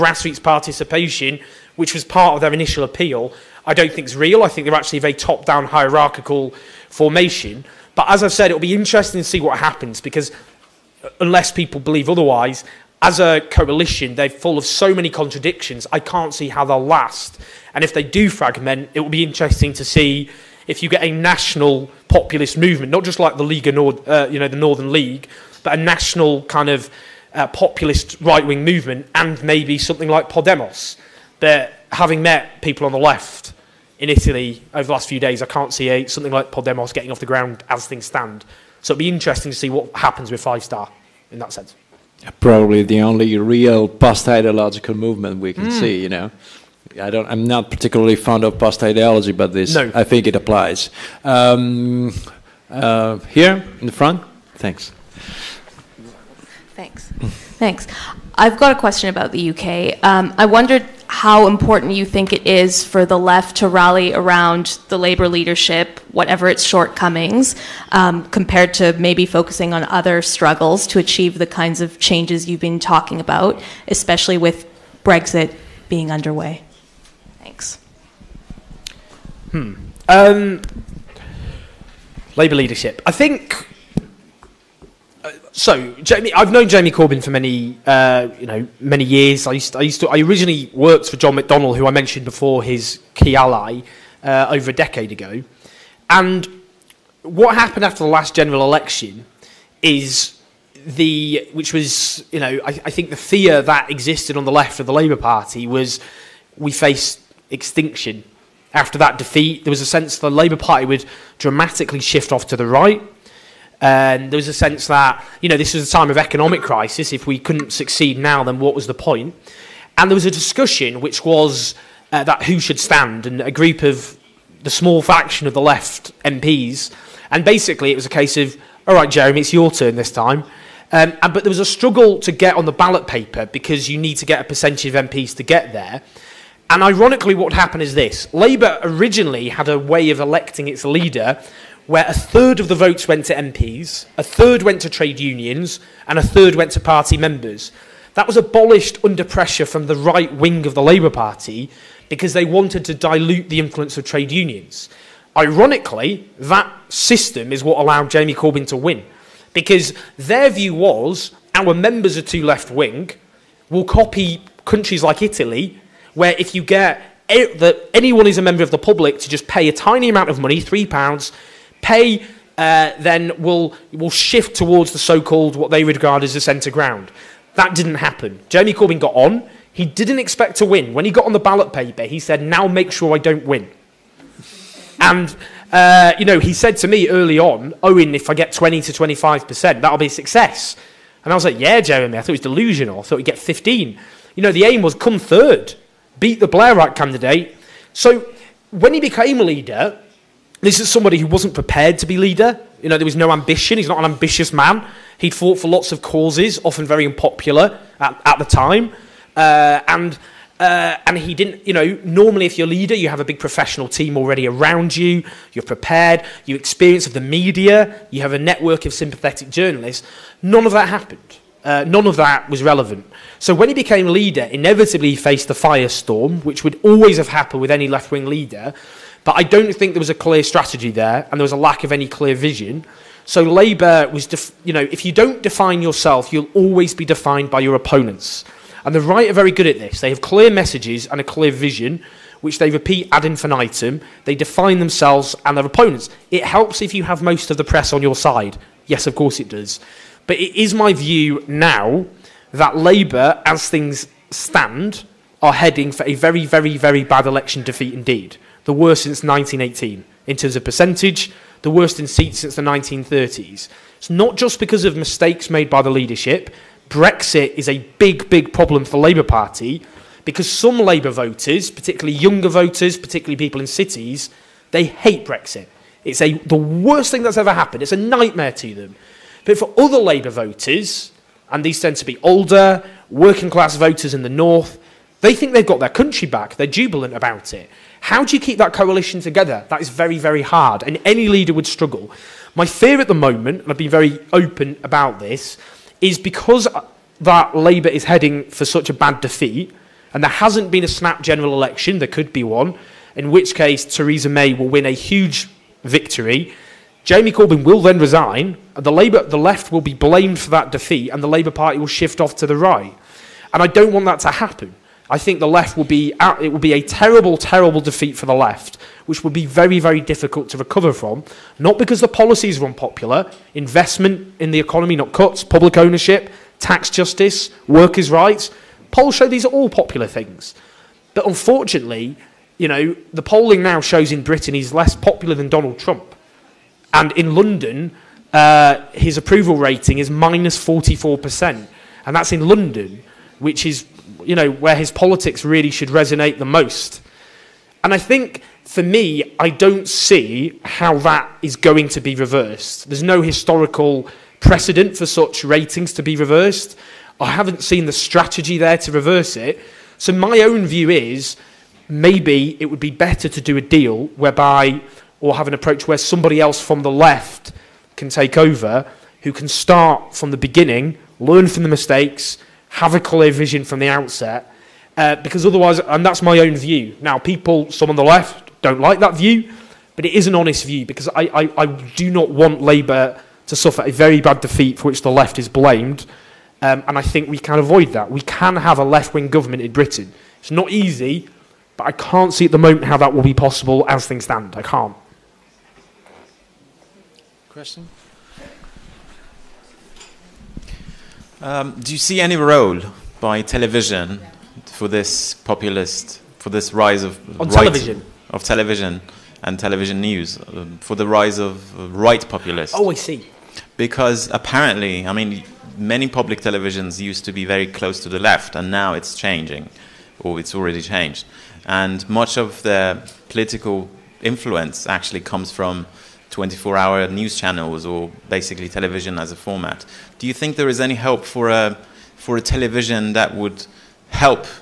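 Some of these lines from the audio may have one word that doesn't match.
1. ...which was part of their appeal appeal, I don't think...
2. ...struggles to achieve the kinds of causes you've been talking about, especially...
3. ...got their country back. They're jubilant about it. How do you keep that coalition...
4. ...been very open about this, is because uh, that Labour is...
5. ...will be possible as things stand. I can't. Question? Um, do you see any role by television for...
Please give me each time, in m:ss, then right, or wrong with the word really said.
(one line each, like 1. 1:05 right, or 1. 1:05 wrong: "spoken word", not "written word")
1. 0:01 wrong: "initial", not "appeal"
2. 1:10 wrong: "changes", not "causes"
3. 4:45 right
4. 4:53 right
5. 6:33 right.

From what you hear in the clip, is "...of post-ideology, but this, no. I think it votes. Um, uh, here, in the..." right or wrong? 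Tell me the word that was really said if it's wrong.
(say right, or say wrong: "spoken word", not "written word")
wrong: "applies", not "votes".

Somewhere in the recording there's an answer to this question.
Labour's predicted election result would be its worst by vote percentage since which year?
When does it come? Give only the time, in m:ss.
4:19.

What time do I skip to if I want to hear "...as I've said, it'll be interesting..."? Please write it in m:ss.
0:08.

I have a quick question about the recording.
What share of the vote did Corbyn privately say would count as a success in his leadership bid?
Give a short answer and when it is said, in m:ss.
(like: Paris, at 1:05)
20 to 25 percent, at 3:08.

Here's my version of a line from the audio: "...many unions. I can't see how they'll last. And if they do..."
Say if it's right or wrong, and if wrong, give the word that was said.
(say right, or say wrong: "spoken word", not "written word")
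wrong: "contradictions", not "unions".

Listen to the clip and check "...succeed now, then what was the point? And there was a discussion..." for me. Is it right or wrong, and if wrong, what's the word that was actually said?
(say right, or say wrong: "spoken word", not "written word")
right.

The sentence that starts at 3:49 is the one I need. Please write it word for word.
But I don't think there was a clear strategy there, and there was a lack of any clear vision.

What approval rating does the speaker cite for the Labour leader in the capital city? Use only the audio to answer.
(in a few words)
-44%.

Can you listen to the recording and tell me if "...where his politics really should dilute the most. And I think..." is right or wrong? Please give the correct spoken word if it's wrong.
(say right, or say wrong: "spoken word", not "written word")
wrong: "resonate", not "dilute".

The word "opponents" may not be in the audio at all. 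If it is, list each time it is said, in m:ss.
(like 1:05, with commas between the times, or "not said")
3:57, 4:05.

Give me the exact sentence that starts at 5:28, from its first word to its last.
Polls show these are all popular things.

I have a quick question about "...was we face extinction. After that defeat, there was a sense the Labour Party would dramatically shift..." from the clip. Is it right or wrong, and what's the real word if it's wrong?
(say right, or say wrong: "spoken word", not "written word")
right.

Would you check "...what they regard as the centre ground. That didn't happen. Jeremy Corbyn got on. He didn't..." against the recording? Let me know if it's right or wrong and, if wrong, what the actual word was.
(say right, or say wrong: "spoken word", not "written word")
right.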